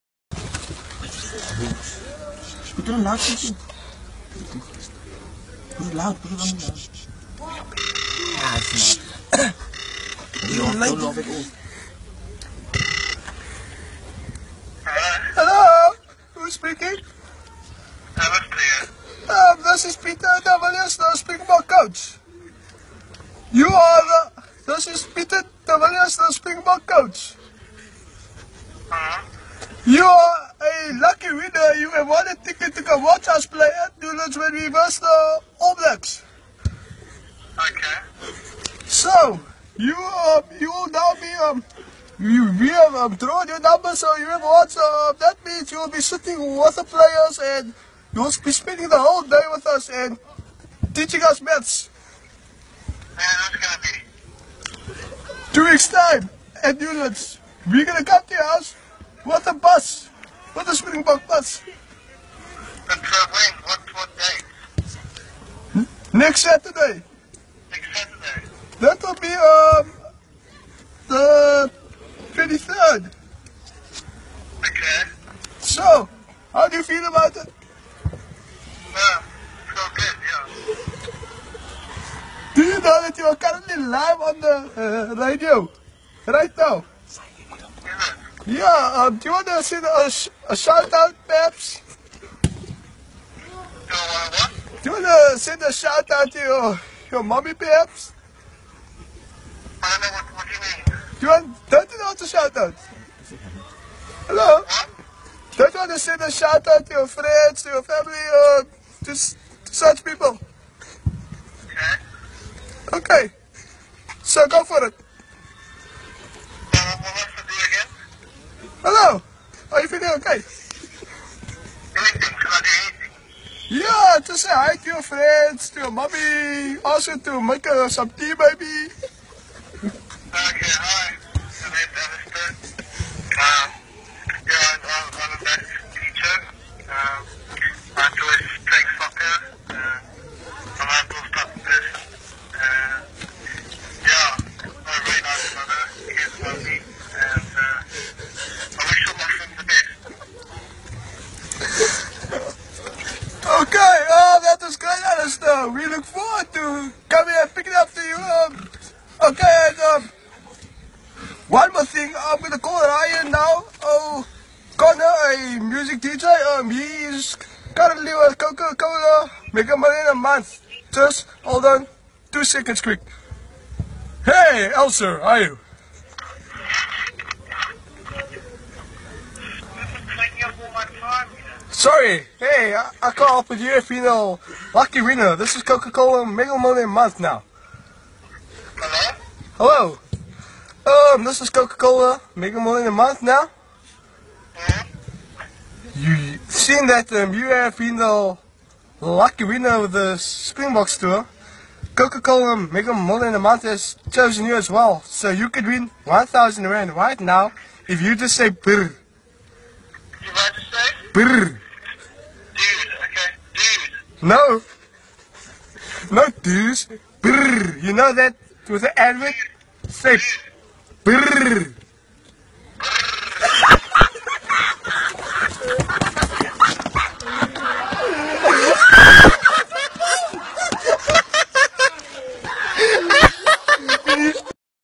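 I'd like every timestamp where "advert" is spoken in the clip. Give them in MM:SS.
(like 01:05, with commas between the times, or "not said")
03:38.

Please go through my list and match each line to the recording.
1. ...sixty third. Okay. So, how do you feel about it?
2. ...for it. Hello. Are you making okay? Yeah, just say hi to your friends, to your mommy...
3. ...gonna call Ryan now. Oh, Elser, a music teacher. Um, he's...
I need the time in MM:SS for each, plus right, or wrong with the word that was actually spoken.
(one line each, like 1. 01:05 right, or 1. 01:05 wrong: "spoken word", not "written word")
1. 01:12 wrong: "twenty", not "sixty"
2. 01:54 wrong: "feeling", not "making"
3. 02:42 wrong: "Connor", not "Elser".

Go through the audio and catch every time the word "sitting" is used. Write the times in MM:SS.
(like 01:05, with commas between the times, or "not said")
00:46.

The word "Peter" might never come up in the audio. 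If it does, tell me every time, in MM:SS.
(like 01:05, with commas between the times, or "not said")
00:19, 00:25.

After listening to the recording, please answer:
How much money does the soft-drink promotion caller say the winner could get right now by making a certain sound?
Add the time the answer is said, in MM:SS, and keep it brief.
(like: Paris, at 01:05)
1,000 Rand, at 03:26.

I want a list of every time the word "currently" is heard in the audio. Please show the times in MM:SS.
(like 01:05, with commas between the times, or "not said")
01:23, 02:47.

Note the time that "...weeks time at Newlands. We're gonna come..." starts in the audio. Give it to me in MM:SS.
00:55.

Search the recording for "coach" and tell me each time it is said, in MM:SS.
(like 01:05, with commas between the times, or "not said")
00:21, 00:26.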